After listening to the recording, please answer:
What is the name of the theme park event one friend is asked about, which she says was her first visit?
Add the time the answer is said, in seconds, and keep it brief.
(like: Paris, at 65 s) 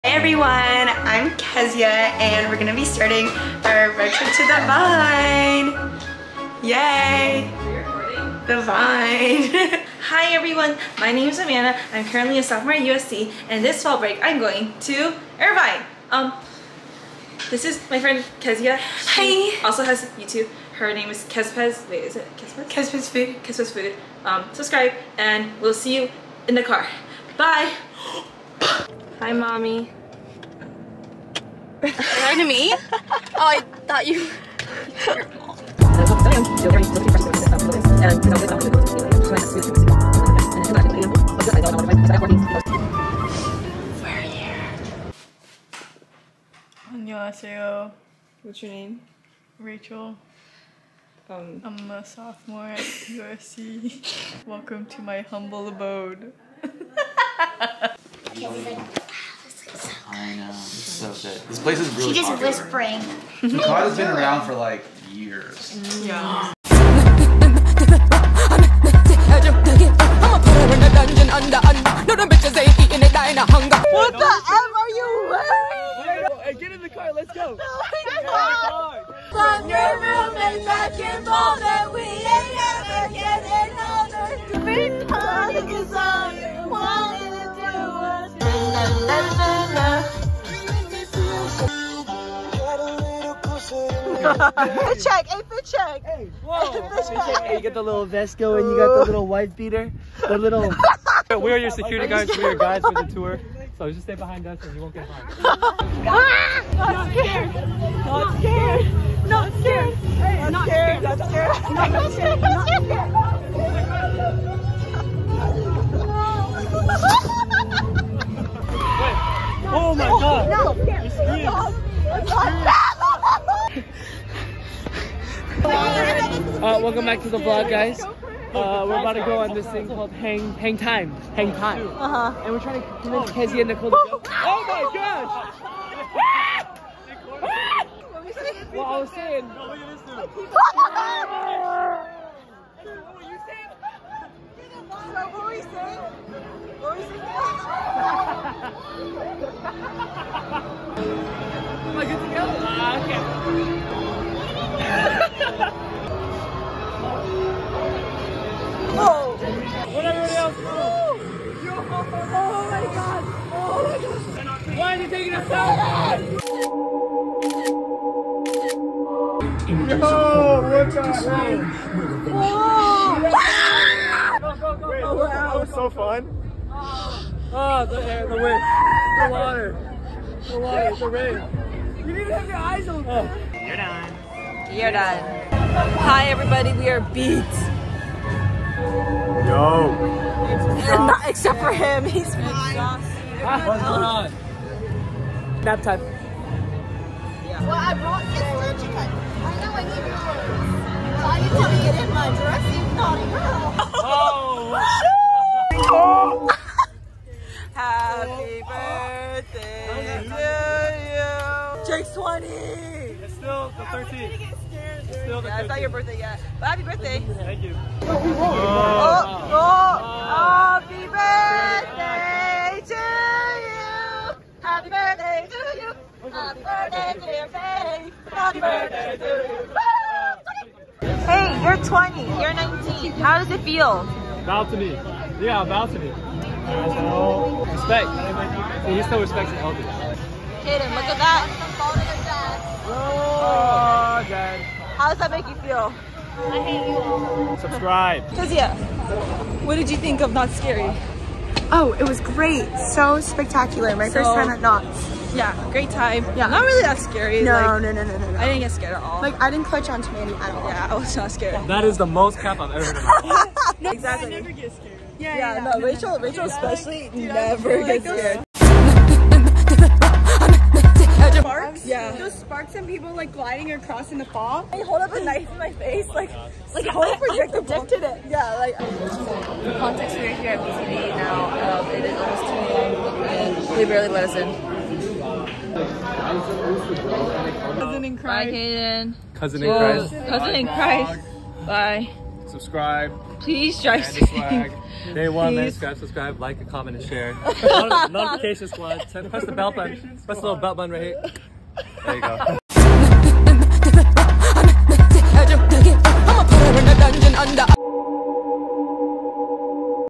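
Knott's Scary, at 250 s.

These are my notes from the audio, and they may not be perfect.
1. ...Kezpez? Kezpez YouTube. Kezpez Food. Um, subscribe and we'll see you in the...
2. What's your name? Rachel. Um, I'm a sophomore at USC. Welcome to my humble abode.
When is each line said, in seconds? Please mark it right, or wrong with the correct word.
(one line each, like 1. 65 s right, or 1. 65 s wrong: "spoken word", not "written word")
1. 22 s wrong: "Food", not "YouTube"
2. 48 s right.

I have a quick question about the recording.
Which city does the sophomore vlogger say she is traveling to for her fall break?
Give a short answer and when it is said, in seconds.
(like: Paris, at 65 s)
Irvine, at 15 s.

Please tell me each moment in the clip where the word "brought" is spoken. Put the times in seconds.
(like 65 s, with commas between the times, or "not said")
197 s.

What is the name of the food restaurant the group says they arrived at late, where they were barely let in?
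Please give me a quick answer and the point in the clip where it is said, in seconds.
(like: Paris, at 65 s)
BCD, at 280 s.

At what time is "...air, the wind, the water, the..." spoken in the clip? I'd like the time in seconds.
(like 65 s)
178 s.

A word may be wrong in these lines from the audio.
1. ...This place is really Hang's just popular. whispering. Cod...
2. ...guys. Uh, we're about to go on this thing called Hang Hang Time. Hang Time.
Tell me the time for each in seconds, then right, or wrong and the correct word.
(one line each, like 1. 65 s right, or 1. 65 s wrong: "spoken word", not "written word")
1. 61 s wrong: "She", not "Hang"
2. 127 s right.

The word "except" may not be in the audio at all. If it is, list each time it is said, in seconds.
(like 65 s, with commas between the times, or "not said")
191 s.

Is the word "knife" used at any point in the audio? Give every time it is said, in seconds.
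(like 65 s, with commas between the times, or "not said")
275 s.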